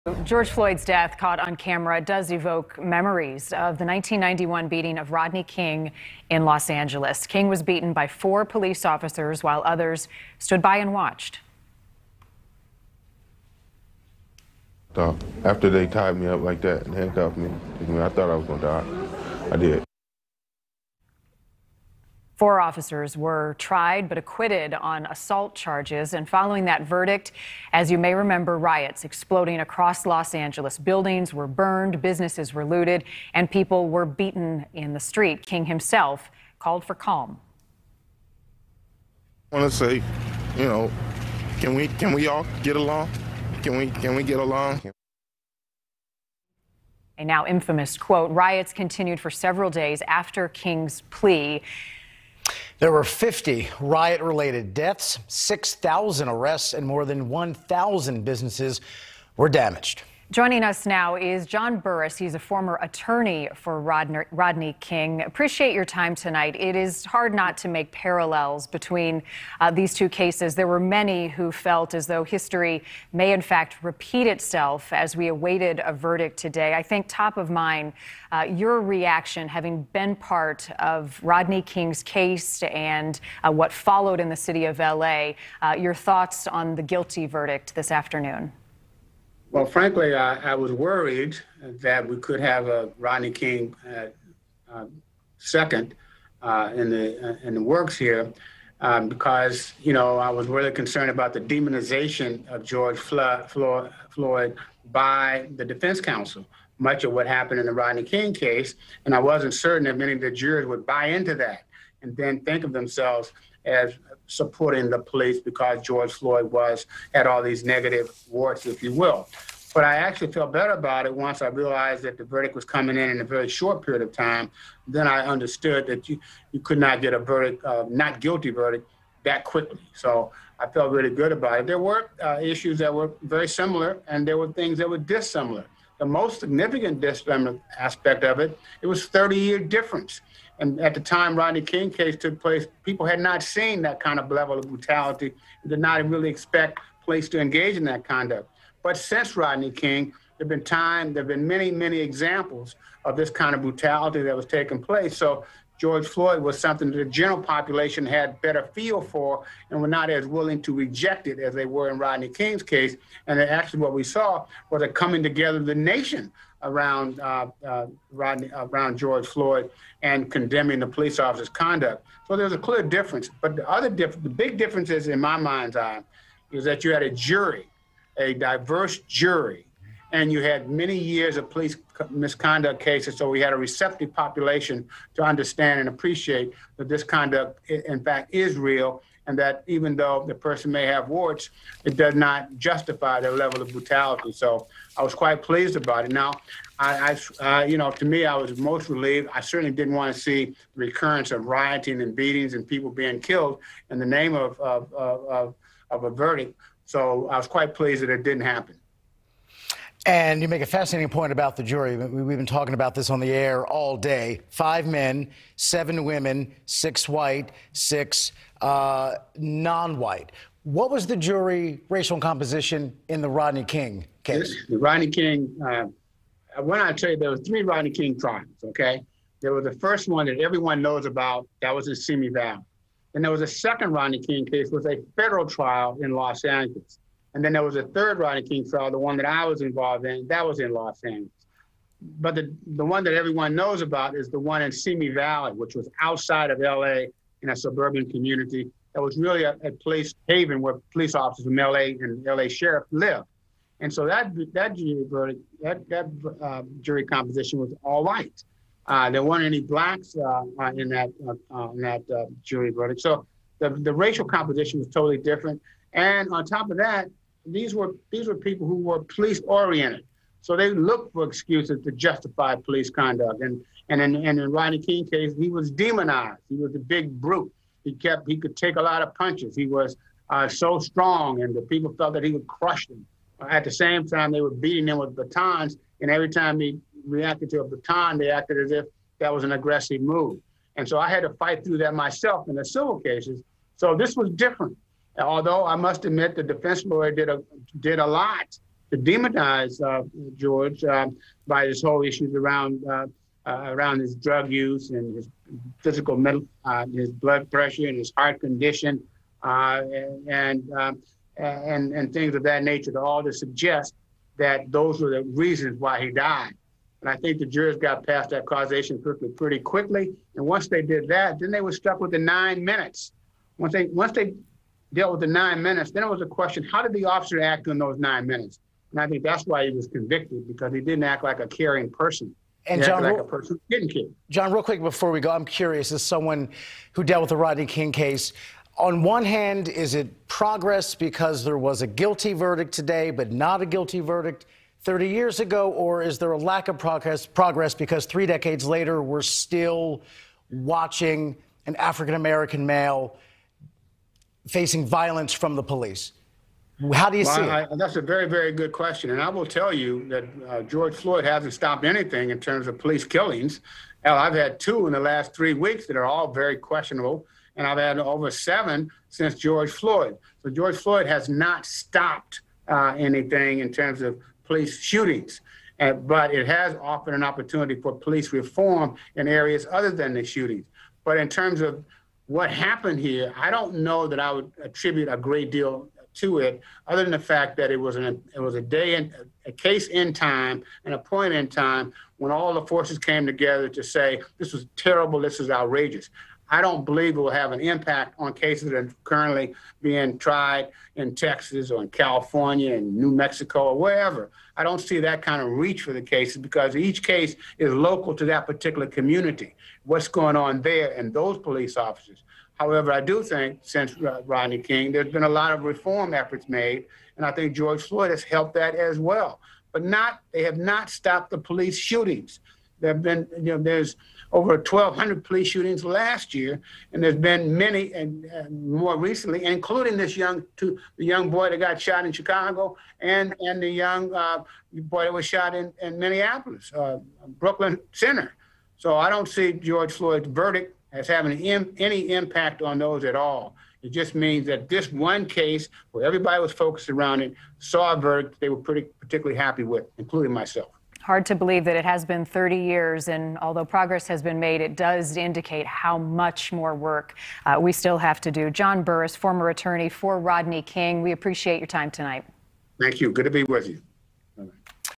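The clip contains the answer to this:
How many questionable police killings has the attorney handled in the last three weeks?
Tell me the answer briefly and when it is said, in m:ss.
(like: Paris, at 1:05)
2, at 6:04.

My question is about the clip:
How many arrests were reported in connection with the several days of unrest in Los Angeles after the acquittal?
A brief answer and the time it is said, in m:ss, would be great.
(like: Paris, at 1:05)
6,000, at 0:55.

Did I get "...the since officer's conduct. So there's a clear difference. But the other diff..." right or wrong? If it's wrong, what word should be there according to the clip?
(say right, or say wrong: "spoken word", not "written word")
wrong: "police", not "since".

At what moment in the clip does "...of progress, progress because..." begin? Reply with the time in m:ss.
5:46.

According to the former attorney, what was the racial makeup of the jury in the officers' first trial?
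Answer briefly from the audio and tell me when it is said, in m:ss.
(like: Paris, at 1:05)
All white, at 4:17.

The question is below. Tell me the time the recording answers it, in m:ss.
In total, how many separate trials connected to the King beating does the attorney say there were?
3:47.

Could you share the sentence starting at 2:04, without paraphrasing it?
Then I understood that you, you could not get a verdict, uh, not guilty verdict, that quickly.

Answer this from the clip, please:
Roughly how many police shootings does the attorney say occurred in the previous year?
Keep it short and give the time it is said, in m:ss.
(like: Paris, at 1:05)
over 1,200, at 7:04.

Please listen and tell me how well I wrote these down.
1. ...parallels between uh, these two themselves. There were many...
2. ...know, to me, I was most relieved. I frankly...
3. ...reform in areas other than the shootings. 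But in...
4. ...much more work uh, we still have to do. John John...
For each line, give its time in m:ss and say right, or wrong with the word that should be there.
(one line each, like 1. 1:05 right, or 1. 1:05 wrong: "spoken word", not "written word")
1. 1:07 wrong: "cases", not "themselves"
2. 3:17 wrong: "certainly", not "frankly"
3. 6:18 right
4. 7:35 wrong: "Burris", not "John".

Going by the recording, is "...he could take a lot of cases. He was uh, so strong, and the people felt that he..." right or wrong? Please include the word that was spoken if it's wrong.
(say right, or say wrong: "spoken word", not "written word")
wrong: "punches", not "cases".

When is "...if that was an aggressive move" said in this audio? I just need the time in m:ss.
4:48.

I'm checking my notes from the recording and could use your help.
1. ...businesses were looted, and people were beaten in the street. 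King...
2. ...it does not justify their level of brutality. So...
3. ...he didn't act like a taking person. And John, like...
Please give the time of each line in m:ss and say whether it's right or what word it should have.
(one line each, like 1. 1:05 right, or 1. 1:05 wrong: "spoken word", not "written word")
1. 0:32 right
2. 3:11 right
3. 5:30 wrong: "caring", not "taking".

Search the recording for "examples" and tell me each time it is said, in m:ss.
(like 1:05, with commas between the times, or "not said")
2:31.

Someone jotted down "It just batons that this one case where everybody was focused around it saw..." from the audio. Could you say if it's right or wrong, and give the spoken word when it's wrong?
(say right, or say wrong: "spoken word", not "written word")
wrong: "means", not "batons".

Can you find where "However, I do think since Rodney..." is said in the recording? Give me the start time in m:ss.
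6:52.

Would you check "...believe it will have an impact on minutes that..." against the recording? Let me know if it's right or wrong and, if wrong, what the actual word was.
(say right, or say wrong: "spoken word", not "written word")
wrong: "cases", not "minutes".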